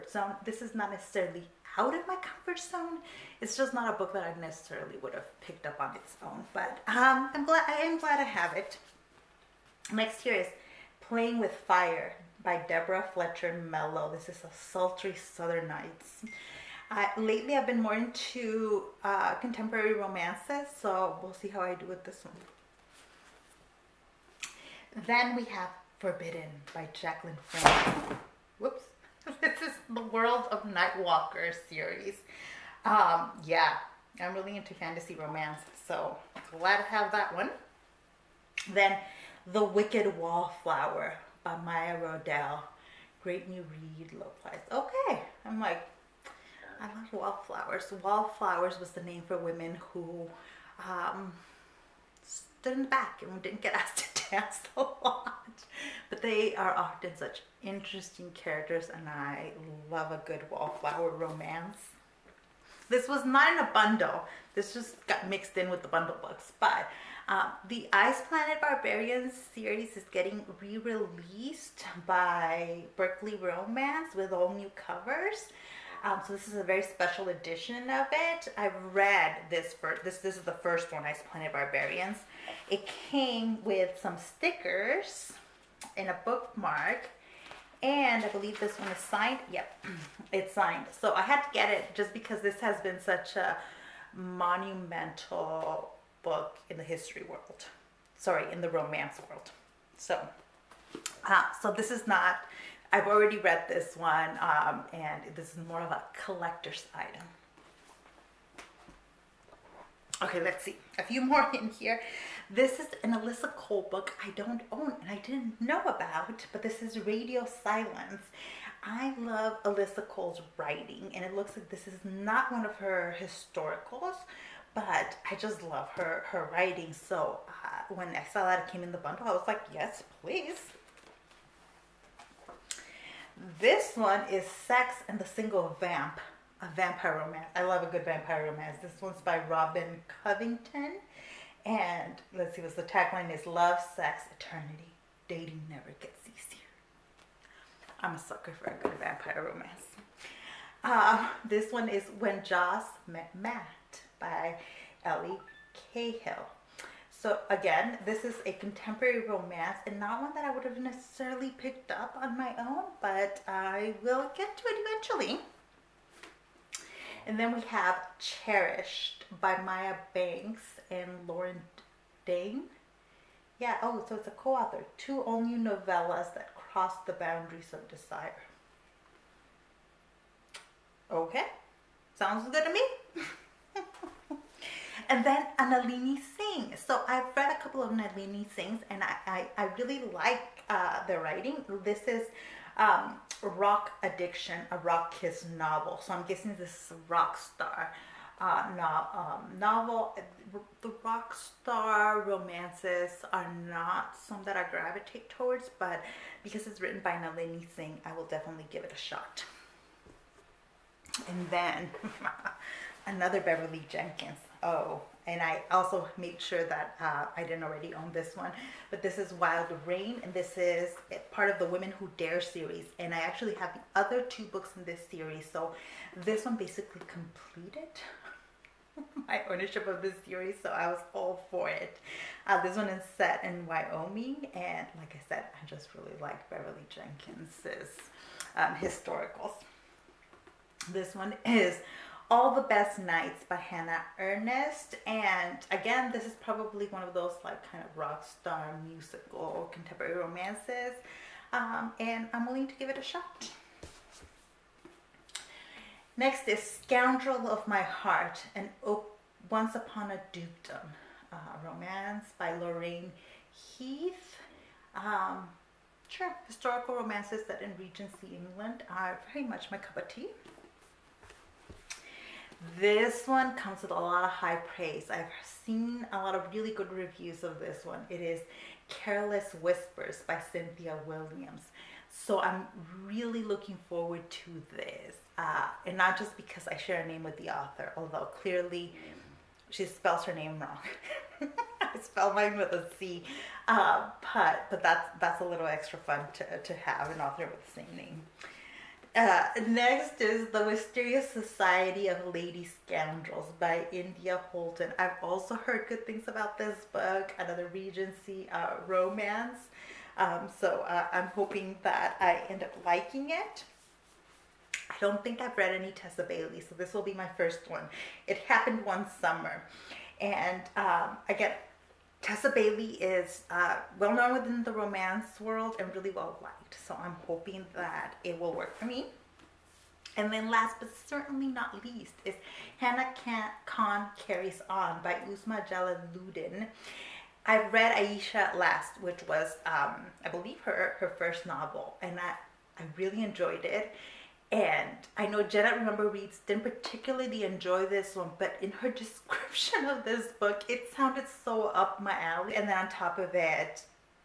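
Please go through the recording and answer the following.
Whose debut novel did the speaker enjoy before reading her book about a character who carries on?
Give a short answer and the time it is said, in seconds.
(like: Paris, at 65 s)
Uzma Jalaluddin, at 335 s.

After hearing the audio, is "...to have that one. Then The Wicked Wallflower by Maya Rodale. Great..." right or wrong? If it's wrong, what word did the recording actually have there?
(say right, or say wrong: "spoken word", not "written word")
right.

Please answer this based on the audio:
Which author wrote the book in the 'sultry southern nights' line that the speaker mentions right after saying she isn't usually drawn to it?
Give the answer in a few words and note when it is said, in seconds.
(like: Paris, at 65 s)
Deborah Fletcher Mello, at 12 s.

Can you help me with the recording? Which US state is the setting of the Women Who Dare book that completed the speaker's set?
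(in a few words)
Wyoming.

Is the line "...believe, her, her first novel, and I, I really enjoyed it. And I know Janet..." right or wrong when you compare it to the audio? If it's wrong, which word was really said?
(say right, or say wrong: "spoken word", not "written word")
right.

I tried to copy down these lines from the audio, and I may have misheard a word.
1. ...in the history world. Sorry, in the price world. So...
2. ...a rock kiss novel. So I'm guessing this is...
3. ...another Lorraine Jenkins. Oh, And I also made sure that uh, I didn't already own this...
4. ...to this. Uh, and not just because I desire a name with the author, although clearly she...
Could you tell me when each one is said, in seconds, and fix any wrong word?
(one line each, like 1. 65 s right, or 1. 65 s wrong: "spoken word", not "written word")
1. 96 s wrong: "romance", not "price"
2. 194 s right
3. 213 s wrong: "Beverly", not "Lorraine"
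4. 284 s wrong: "share", not "desire".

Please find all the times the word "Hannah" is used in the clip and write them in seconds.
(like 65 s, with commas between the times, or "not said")
243 s, 332 s.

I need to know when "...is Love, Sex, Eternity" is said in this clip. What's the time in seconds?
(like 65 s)
143 s.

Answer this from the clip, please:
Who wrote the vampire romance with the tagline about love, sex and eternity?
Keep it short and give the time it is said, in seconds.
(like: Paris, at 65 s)
Robin Covington, at 139 s.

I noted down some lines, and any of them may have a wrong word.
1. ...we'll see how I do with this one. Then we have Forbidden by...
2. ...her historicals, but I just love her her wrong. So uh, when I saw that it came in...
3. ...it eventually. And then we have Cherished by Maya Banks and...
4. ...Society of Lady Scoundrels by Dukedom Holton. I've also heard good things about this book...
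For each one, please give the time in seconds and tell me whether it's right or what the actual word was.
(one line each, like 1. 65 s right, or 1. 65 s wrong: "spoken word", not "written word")
1. 21 s right
2. 122 s wrong: "writing", not "wrong"
3. 164 s right
4. 301 s wrong: "India", not "Dukedom".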